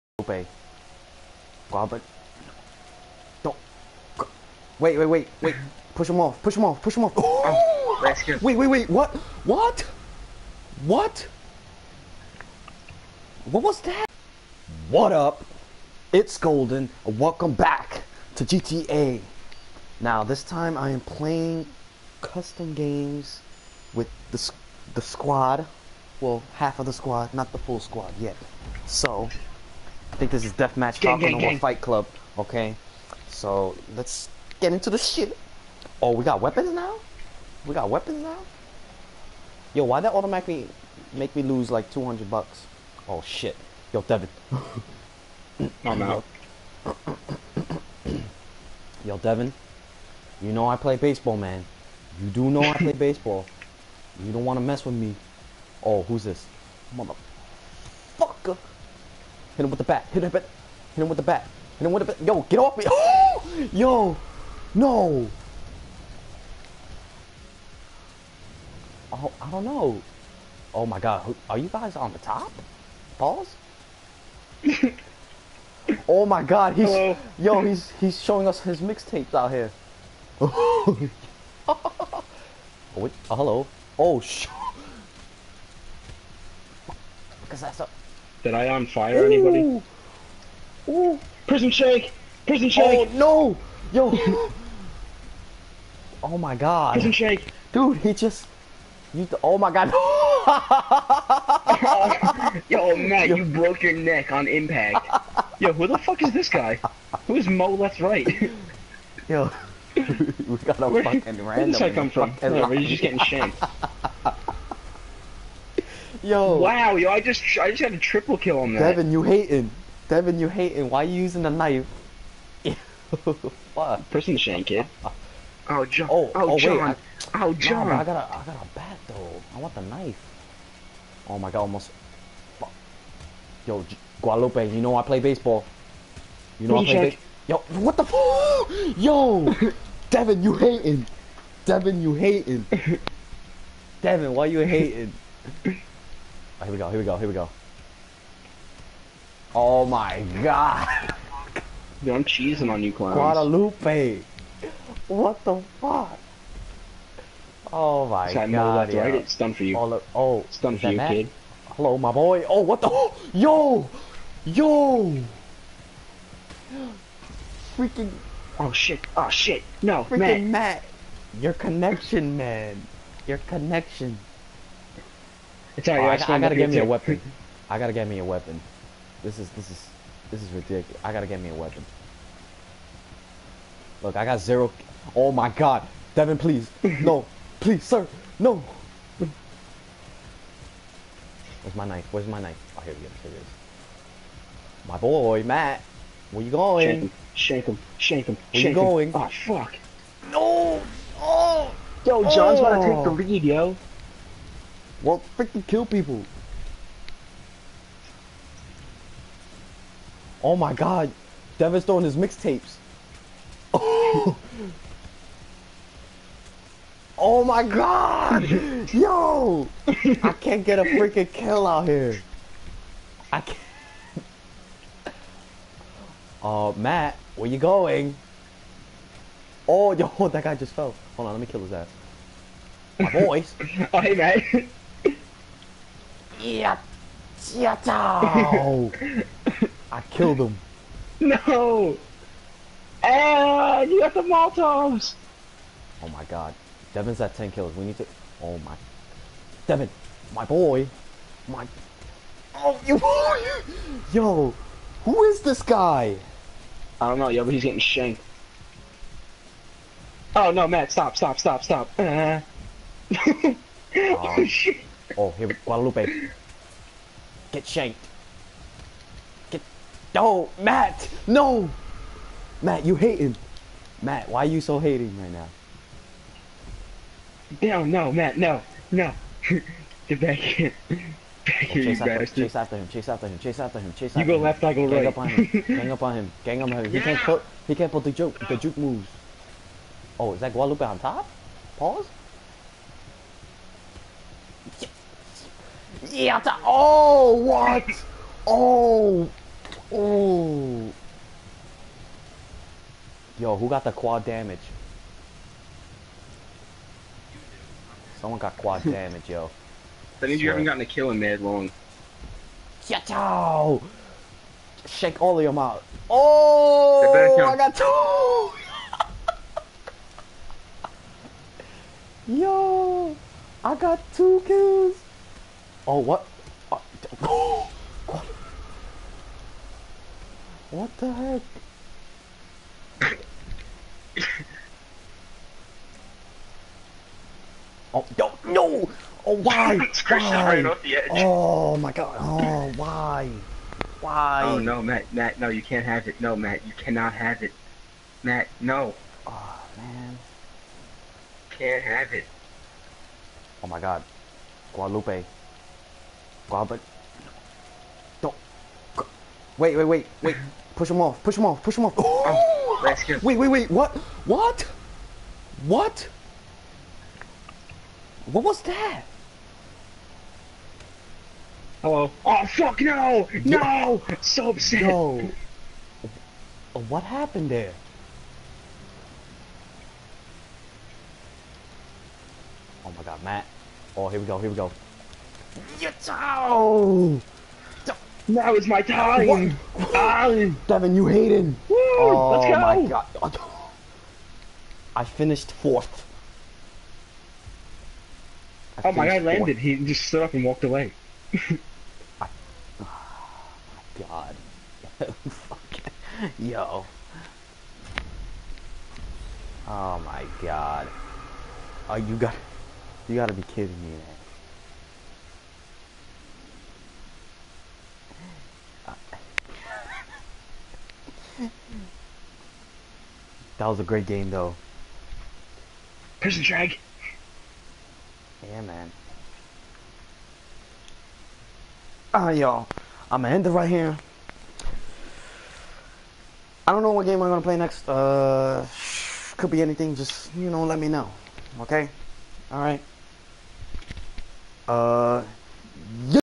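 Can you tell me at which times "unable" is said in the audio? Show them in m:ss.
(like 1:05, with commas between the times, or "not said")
not said.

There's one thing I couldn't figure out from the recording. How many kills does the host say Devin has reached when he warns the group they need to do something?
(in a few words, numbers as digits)
10.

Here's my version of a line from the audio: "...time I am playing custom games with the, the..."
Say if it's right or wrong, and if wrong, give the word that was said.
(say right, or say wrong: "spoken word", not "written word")
right.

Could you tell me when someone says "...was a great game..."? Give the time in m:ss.
7:03.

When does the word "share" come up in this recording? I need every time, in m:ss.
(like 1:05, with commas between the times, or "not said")
not said.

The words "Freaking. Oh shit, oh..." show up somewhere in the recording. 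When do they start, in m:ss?
2:47.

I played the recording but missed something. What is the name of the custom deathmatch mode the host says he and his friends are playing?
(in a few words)
Falcon Fight Club.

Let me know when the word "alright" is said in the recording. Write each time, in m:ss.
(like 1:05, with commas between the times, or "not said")
2:55, 7:12.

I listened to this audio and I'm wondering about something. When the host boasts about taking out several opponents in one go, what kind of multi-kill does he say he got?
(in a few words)
triple kill.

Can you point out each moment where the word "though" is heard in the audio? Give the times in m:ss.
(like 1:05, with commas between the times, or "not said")
2:09, 7:04.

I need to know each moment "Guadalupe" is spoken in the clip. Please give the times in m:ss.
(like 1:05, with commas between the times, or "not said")
2:14, 2:33, 4:25, 4:50, 5:54.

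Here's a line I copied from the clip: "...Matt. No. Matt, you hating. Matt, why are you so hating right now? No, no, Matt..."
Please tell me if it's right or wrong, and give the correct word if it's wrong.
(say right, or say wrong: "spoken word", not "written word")
right.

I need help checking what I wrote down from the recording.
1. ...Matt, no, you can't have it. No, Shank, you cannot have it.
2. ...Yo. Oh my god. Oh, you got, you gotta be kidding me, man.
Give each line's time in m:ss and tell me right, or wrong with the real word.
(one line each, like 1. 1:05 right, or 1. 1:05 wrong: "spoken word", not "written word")
1. 5:45 wrong: "Matt", not "Shank"
2. 6:46 right.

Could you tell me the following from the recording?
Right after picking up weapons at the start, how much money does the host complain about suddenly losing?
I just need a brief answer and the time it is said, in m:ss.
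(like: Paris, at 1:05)
200, at 0:41.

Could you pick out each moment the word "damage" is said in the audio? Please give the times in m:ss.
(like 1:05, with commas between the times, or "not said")
5:04, 5:08.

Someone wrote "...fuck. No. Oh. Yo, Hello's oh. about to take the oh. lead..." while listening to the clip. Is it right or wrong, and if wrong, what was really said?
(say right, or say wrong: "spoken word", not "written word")
wrong: "John", not "Hello".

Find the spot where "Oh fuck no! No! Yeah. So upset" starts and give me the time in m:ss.
6:12.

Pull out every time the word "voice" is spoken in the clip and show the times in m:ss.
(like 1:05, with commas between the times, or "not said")
3:53.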